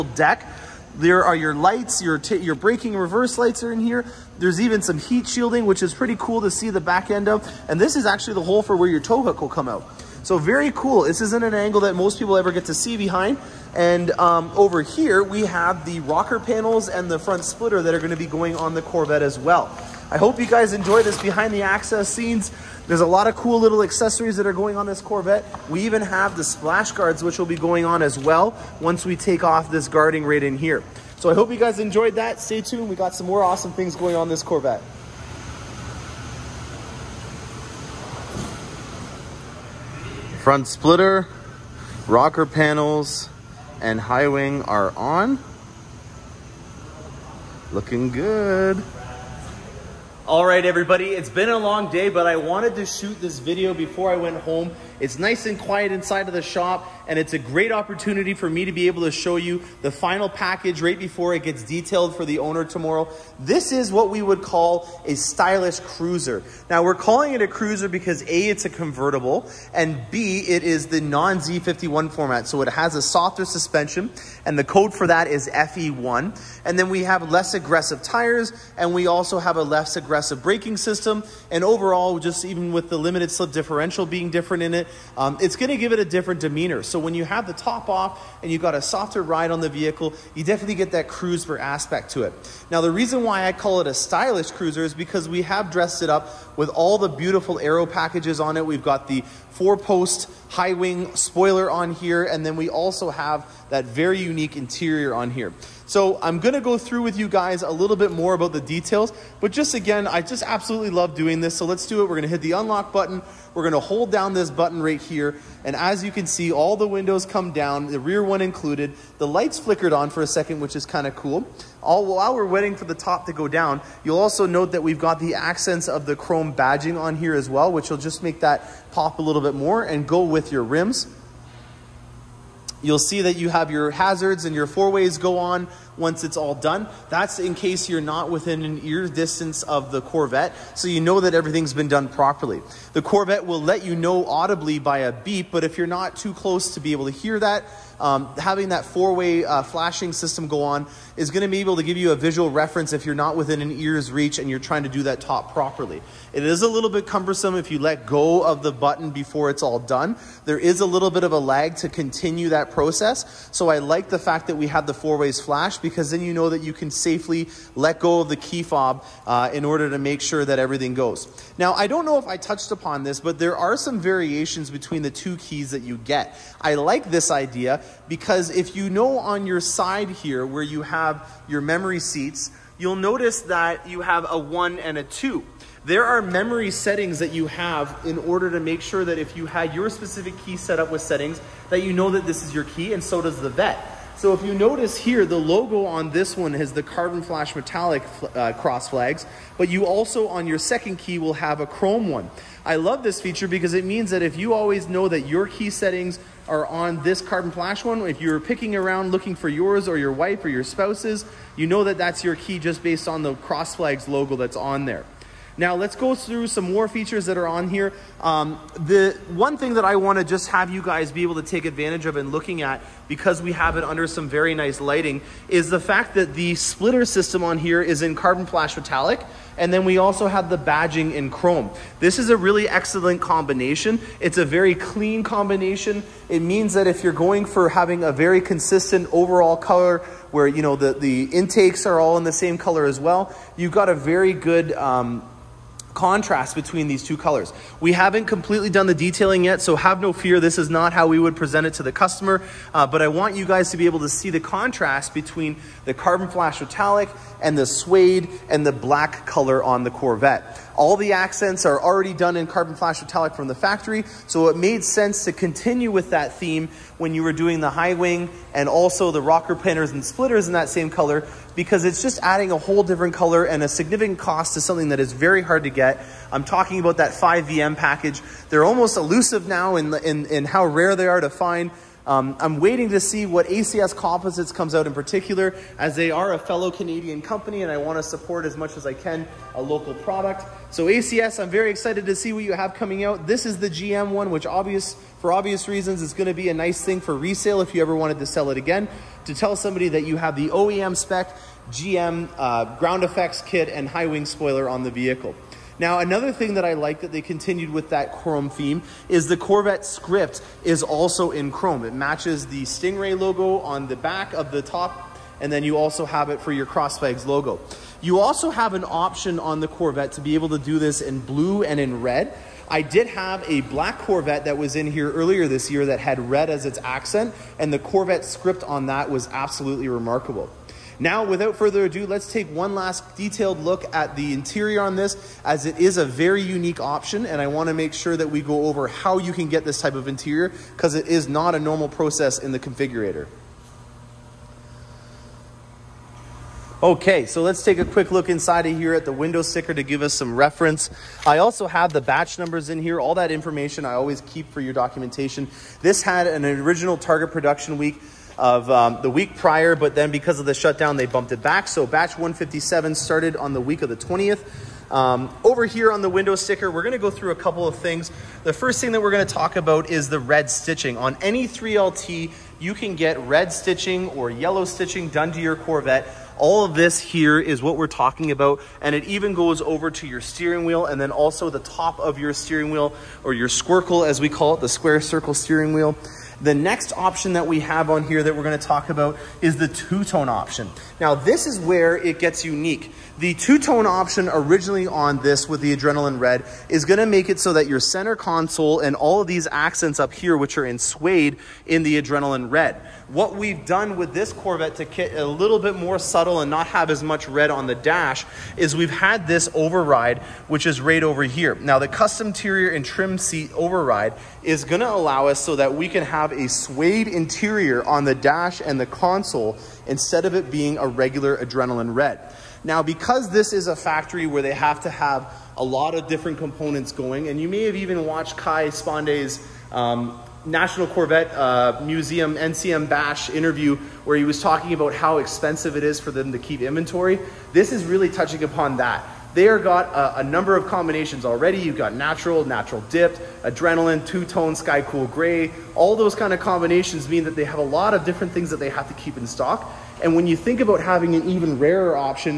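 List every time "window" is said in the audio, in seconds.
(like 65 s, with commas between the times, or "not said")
116 s, 349 s, 366 s.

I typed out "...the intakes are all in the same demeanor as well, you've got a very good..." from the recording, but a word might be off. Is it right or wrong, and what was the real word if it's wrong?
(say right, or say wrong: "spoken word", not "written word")
wrong: "color", not "demeanor".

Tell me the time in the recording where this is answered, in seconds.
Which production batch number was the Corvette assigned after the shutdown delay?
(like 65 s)
361 s.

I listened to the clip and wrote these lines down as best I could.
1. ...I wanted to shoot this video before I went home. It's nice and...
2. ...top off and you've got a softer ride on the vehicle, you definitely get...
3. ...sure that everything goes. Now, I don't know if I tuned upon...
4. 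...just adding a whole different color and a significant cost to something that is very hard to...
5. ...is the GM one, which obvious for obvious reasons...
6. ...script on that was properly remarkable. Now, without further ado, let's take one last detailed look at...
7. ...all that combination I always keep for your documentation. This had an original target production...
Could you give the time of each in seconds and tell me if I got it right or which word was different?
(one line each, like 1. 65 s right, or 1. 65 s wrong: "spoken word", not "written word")
1. 52 s right
2. 87 s right
3. 170 s wrong: "touched", not "tuned"
4. 272 s right
5. 293 s right
6. 328 s wrong: "absolutely", not "properly"
7. 352 s wrong: "information", not "combination".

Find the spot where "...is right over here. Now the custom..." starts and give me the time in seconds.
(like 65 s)
410 s.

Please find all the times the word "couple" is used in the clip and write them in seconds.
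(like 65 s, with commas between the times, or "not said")
367 s.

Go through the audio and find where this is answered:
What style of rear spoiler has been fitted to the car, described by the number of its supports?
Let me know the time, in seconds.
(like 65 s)
99 s.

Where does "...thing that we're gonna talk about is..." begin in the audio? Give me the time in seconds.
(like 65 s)
368 s.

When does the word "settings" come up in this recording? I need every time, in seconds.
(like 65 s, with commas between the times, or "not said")
186 s, 191 s, 205 s.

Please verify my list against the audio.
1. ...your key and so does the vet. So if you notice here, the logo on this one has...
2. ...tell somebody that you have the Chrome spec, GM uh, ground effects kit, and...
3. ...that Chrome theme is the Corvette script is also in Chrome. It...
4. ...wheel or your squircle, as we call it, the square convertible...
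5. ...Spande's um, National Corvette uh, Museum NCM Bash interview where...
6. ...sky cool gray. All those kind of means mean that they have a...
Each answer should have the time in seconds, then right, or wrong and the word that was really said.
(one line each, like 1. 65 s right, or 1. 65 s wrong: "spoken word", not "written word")
1. 192 s right
2. 299 s wrong: "OEM", not "Chrome"
3. 307 s right
4. 382 s wrong: "circle", not "convertible"
5. 428 s right
6. 444 s wrong: "combinations", not "means".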